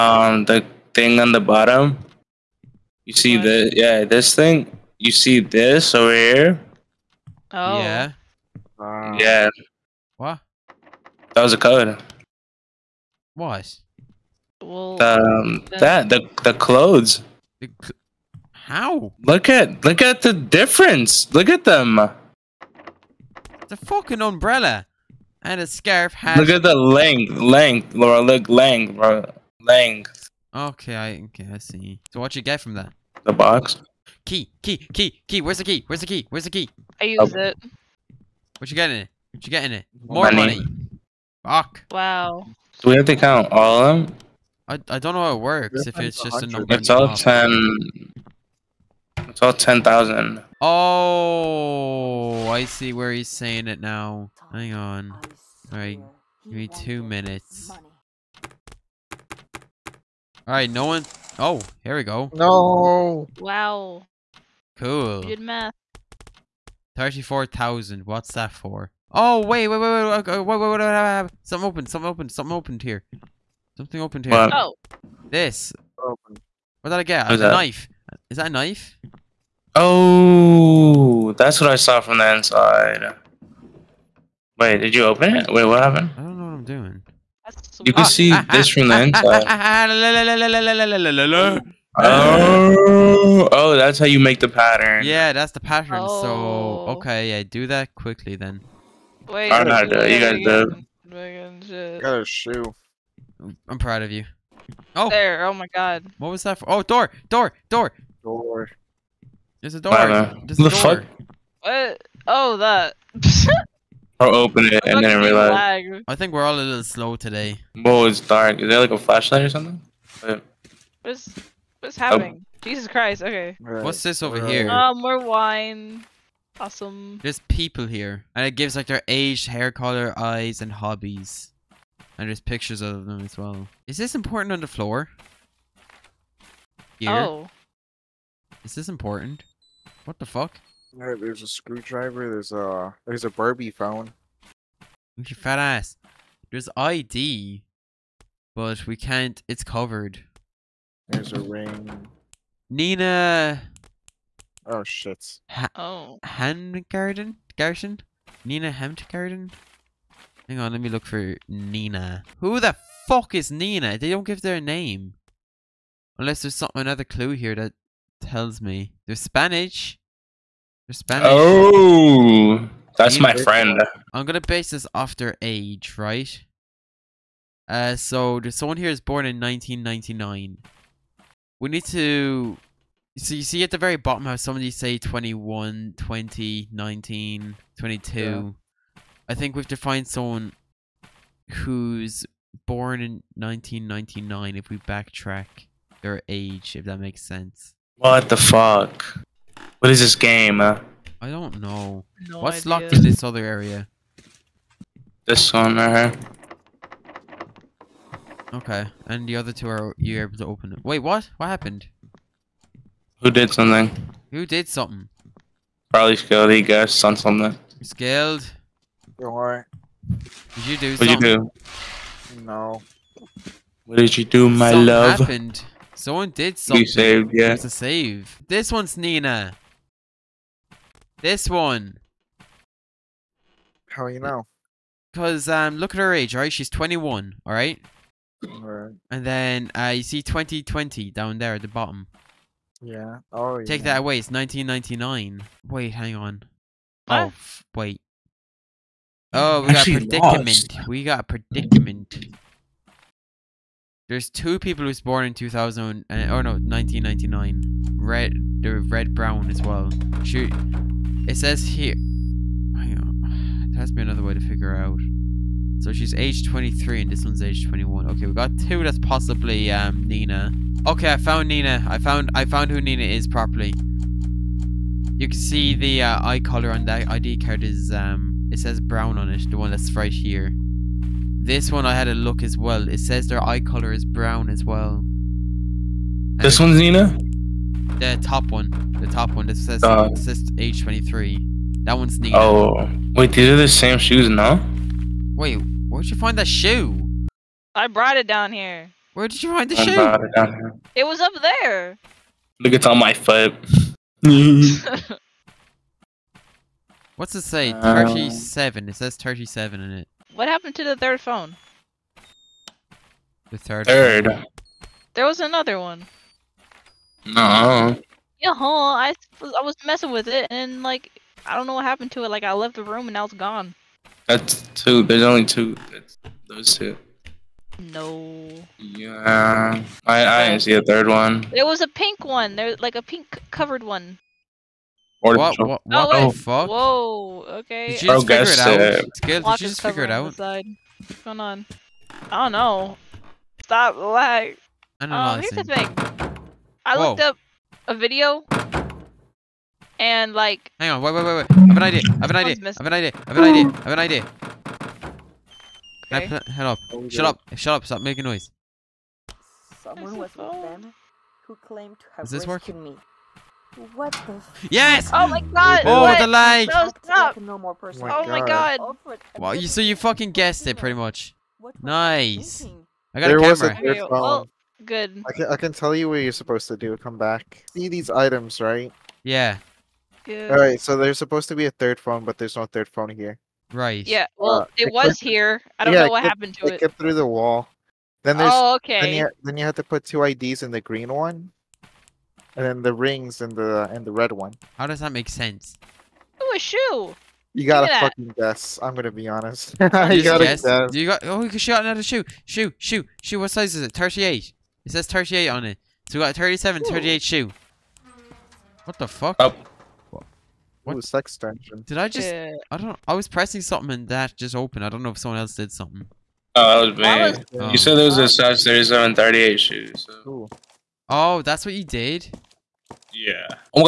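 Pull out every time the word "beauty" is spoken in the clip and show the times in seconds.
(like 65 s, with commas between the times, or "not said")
not said.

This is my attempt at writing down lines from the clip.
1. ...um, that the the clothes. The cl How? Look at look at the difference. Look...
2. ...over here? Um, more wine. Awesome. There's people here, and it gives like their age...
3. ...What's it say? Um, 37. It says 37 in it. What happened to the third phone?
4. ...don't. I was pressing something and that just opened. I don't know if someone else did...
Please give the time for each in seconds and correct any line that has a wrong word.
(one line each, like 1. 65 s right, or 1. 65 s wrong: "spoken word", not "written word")
1. 15 s right
2. 124 s right
3. 307 s right
4. 412 s right.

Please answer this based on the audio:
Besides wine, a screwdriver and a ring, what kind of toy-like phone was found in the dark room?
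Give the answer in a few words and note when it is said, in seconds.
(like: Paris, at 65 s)
Barbie phone, at 143 s.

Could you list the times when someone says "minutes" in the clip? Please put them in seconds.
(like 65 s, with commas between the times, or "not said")
57 s.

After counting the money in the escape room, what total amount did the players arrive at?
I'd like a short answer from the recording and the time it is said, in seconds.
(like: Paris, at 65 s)
34,000, at 66 s.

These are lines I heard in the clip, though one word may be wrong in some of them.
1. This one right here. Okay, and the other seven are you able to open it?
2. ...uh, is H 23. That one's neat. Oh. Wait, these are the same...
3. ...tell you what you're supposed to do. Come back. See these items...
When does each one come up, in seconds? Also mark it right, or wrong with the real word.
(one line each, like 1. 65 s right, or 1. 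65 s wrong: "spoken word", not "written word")
1. 205 s wrong: "two", not "seven"
2. 289 s right
3. 375 s right.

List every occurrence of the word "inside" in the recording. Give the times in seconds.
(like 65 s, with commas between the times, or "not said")
82 s, 89 s.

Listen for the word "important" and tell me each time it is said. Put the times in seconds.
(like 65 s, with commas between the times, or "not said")
134 s, 138 s.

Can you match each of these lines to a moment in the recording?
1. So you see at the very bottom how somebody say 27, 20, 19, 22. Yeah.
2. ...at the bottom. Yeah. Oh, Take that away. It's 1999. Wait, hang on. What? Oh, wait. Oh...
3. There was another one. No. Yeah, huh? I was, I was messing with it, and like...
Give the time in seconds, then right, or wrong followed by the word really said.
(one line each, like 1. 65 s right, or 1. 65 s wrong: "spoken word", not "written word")
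1. 183 s wrong: "21", not "27"
2. 241 s right
3. 315 s right.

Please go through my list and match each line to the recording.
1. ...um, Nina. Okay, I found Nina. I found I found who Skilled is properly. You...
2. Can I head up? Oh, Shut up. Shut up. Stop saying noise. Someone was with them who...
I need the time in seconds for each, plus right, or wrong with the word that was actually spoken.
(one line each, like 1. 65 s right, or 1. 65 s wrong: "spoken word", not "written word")
1. 269 s wrong: "Nina", not "Skilled"
2. 356 s wrong: "making", not "saying".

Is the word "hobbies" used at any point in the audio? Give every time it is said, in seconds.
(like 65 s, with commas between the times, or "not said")
130 s.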